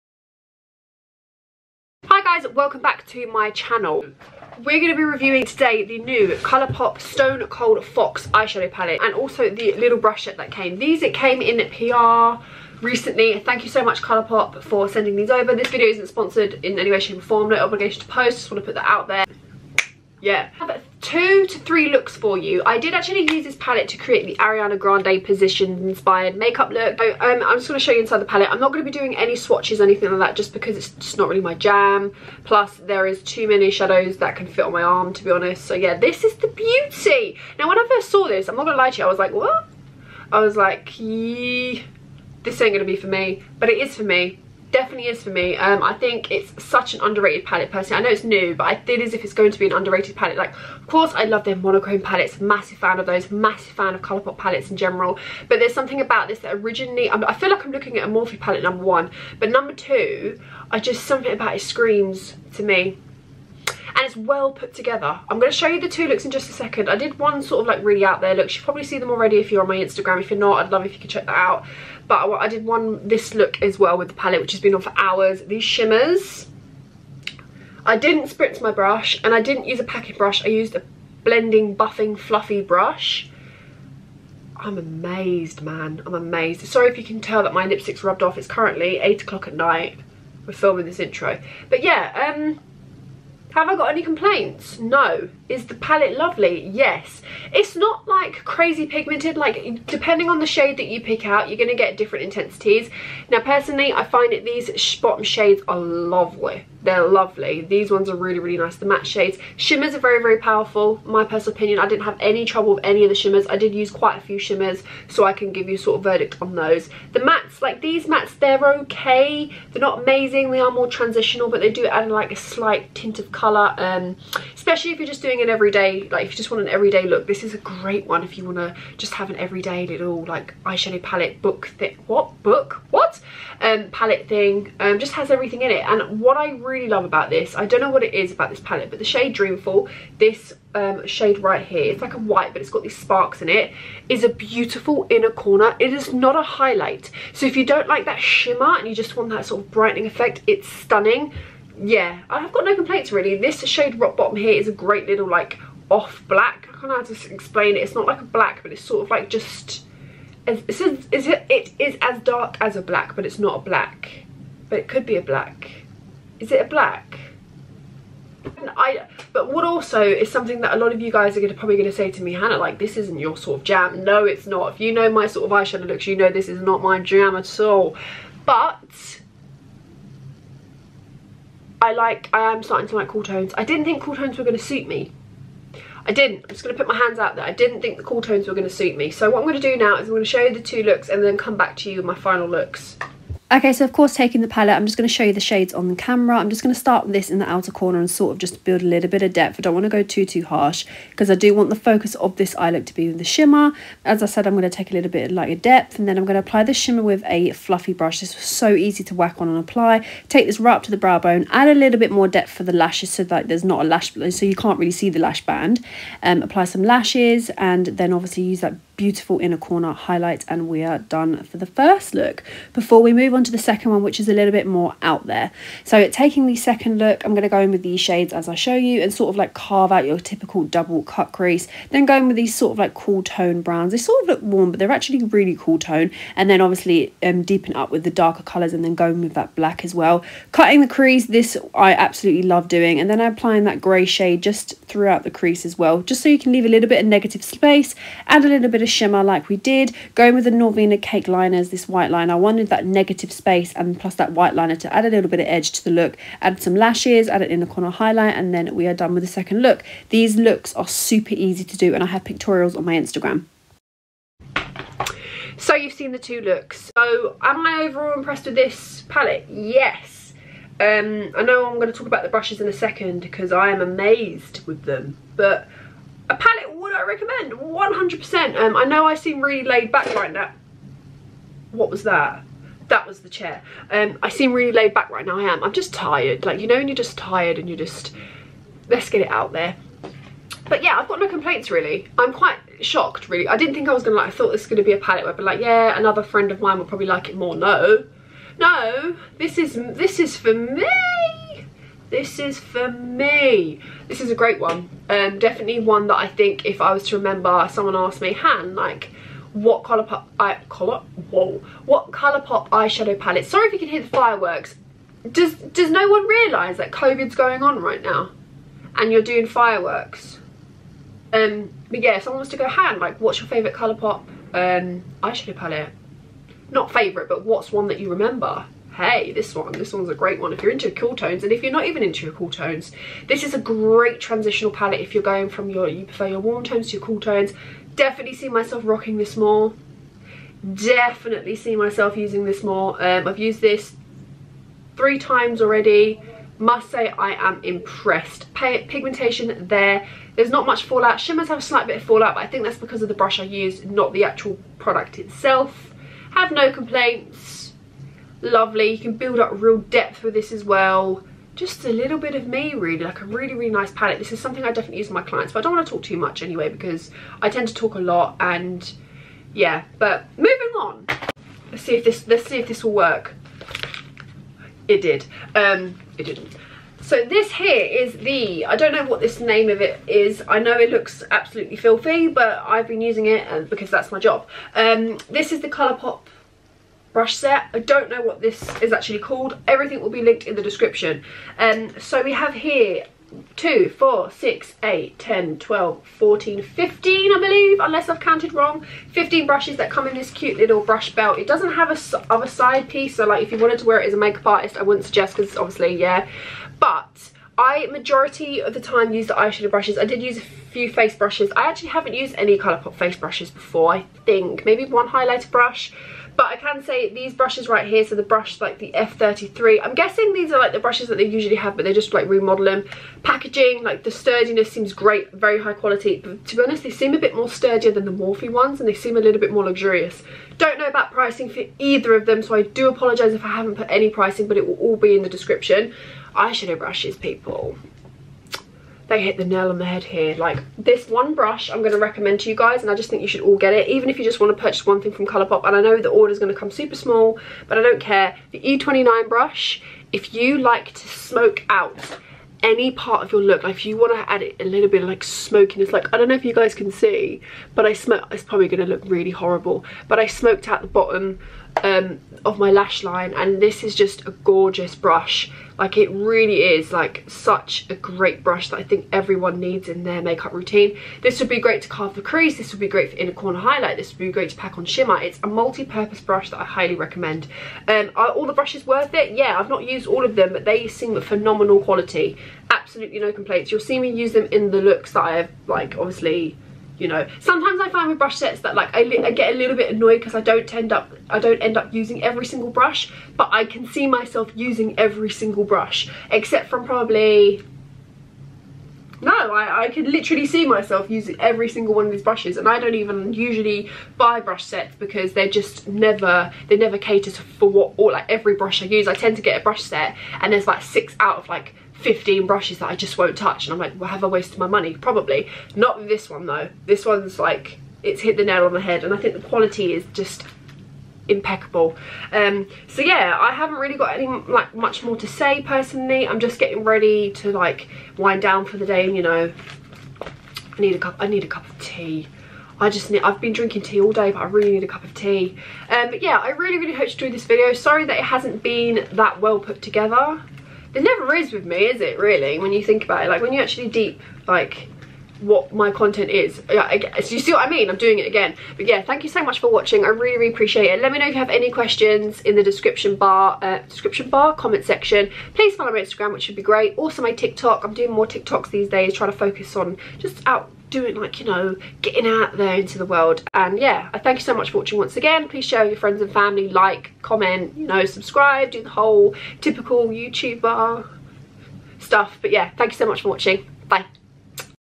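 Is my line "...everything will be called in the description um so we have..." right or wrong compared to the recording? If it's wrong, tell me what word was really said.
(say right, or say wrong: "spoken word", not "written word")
wrong: "linked", not "called".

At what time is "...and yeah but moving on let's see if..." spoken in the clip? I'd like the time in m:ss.
6:08.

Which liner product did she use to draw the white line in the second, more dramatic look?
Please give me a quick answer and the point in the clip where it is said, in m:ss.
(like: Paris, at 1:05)
Norvina Cake Liners, at 4:10.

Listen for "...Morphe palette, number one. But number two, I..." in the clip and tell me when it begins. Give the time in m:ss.
0:58.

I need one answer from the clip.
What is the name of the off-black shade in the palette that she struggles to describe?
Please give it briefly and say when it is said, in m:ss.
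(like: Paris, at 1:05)
Rock Bottom, at 2:33.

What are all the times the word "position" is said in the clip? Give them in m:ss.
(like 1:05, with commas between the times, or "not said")
0:25.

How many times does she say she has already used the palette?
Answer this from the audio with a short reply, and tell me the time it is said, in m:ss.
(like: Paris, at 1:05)
3, at 5:44.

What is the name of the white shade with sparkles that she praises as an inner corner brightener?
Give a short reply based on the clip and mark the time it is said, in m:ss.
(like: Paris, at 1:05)
Dreamful, at 2:19.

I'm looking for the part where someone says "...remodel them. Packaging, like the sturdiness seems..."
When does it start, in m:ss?
7:02.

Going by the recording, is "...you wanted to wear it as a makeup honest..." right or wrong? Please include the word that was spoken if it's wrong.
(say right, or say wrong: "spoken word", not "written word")
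wrong: "artist", not "honest".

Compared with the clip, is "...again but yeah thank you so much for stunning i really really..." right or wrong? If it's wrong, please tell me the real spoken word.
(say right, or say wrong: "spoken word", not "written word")
wrong: "watching", not "stunning".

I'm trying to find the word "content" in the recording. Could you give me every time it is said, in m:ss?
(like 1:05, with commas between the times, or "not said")
9:05.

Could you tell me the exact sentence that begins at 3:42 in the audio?
Before we move on on to the second one, which is a little bit more out there.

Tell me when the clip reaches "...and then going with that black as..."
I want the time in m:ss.
3:58.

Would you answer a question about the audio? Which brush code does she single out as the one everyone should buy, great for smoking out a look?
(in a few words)
E29.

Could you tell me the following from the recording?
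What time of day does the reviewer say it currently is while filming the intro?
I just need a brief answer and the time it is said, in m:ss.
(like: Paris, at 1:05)
8 o'clock, at 1:28.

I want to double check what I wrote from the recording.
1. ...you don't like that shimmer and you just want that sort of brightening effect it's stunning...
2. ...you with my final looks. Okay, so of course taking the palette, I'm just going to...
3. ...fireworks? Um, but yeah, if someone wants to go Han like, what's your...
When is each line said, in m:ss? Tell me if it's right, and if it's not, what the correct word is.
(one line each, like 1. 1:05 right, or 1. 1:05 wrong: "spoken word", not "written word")
1. 2:27 right
2. 3:11 right
3. 5:19 right.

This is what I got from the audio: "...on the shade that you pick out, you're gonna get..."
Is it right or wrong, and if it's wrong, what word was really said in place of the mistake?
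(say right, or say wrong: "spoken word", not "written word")
right.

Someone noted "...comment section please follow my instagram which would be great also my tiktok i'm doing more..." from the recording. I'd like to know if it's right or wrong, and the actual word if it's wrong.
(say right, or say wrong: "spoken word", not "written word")
right.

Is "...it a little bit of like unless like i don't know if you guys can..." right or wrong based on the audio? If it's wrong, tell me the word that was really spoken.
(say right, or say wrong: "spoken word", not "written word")
wrong: "smokiness", not "unless".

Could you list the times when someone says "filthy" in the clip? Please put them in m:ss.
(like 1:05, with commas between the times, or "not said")
6:21.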